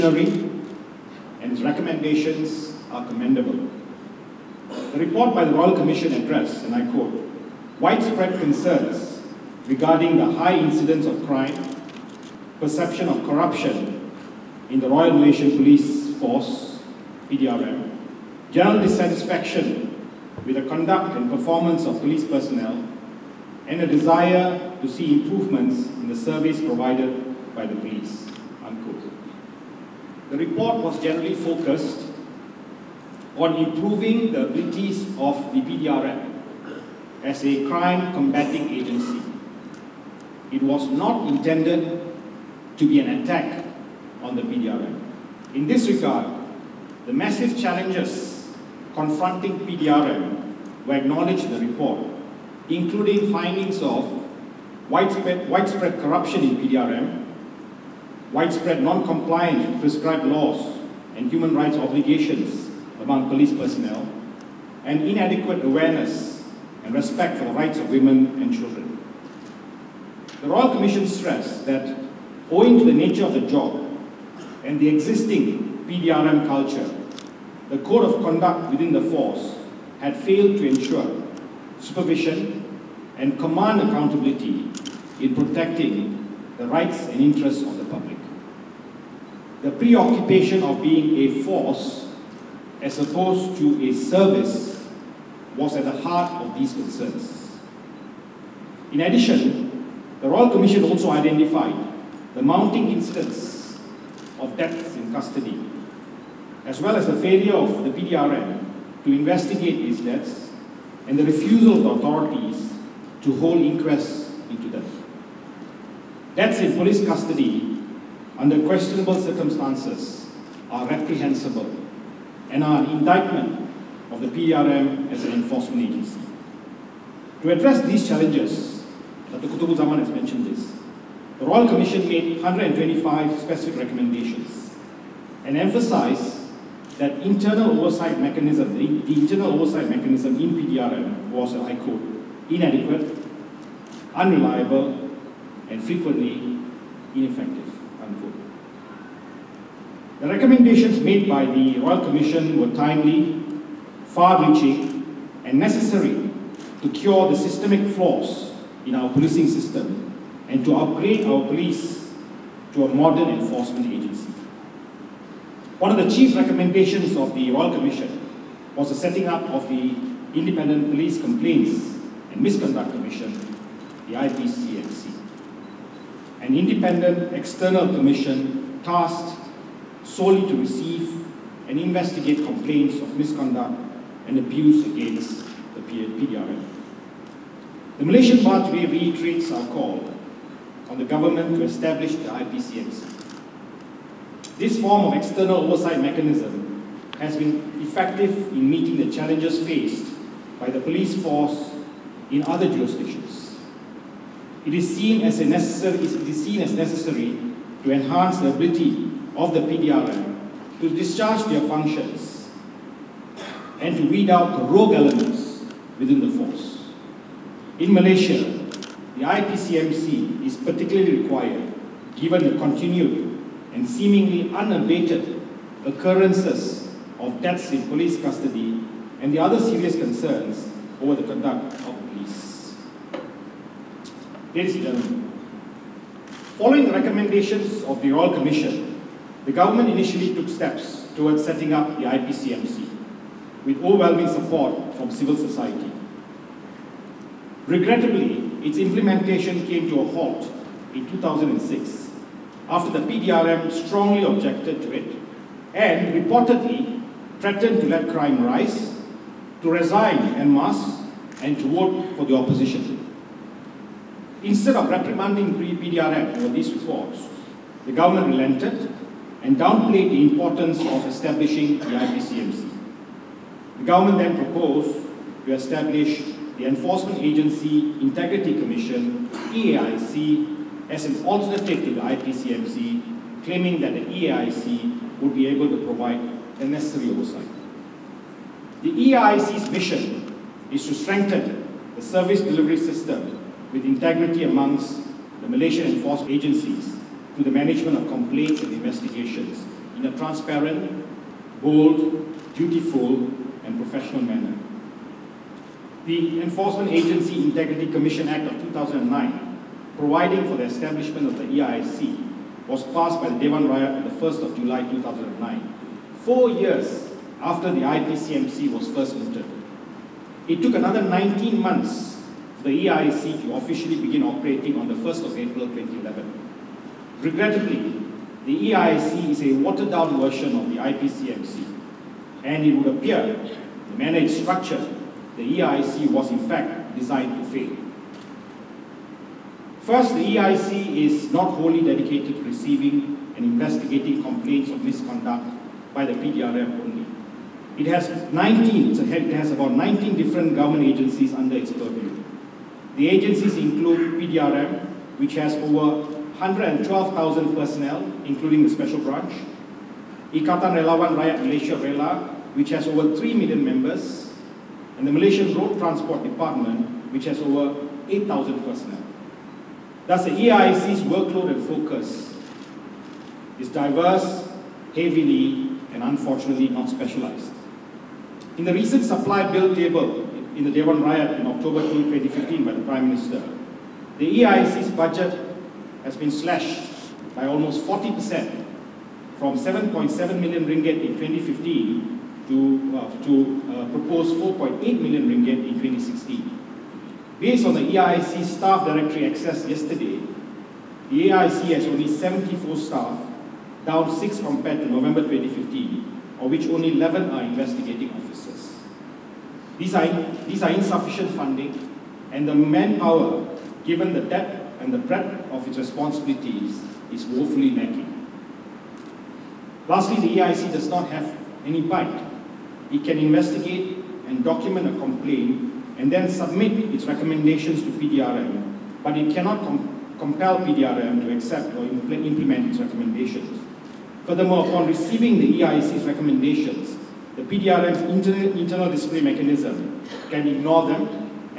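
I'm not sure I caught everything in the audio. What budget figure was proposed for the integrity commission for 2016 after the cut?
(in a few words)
4.8 million ringgit.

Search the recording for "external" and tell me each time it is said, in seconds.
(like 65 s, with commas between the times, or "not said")
177 s, 195 s.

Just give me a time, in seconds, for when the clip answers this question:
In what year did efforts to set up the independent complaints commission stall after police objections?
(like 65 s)
251 s.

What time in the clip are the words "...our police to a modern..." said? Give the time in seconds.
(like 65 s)
161 s.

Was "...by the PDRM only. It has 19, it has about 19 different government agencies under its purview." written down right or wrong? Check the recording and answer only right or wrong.
right.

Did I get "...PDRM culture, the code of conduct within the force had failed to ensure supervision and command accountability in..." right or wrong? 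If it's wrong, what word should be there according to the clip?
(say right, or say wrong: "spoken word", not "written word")
right.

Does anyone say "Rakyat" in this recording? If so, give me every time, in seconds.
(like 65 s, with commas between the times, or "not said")
313 s, 361 s, 381 s.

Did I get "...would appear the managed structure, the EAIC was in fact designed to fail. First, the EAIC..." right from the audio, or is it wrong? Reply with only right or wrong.
right.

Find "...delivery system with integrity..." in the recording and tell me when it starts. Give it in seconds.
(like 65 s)
292 s.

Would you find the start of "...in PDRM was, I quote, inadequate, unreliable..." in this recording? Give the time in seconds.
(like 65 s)
140 s.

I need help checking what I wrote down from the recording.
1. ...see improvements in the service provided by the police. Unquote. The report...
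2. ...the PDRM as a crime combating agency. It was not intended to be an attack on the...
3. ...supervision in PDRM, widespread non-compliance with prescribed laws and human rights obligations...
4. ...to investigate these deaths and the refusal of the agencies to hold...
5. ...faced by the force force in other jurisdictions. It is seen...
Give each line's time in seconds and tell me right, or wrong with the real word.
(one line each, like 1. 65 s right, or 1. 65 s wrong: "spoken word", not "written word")
1. 24 s right
2. 35 s right
3. 56 s wrong: "corruption", not "supervision"
4. 109 s wrong: "authorities", not "agencies"
5. 199 s wrong: "police", not "force".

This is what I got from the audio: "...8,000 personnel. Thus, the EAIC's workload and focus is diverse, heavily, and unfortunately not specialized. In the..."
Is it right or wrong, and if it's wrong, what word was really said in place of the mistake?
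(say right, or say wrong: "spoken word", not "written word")
right.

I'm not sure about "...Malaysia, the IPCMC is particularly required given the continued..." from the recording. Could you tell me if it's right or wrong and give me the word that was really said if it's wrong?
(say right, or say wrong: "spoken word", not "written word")
right.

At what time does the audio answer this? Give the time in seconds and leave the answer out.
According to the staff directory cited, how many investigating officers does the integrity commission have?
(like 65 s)
406 s.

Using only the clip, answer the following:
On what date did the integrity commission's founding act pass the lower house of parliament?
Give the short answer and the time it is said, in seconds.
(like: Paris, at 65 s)
1 July 2009, at 314 s.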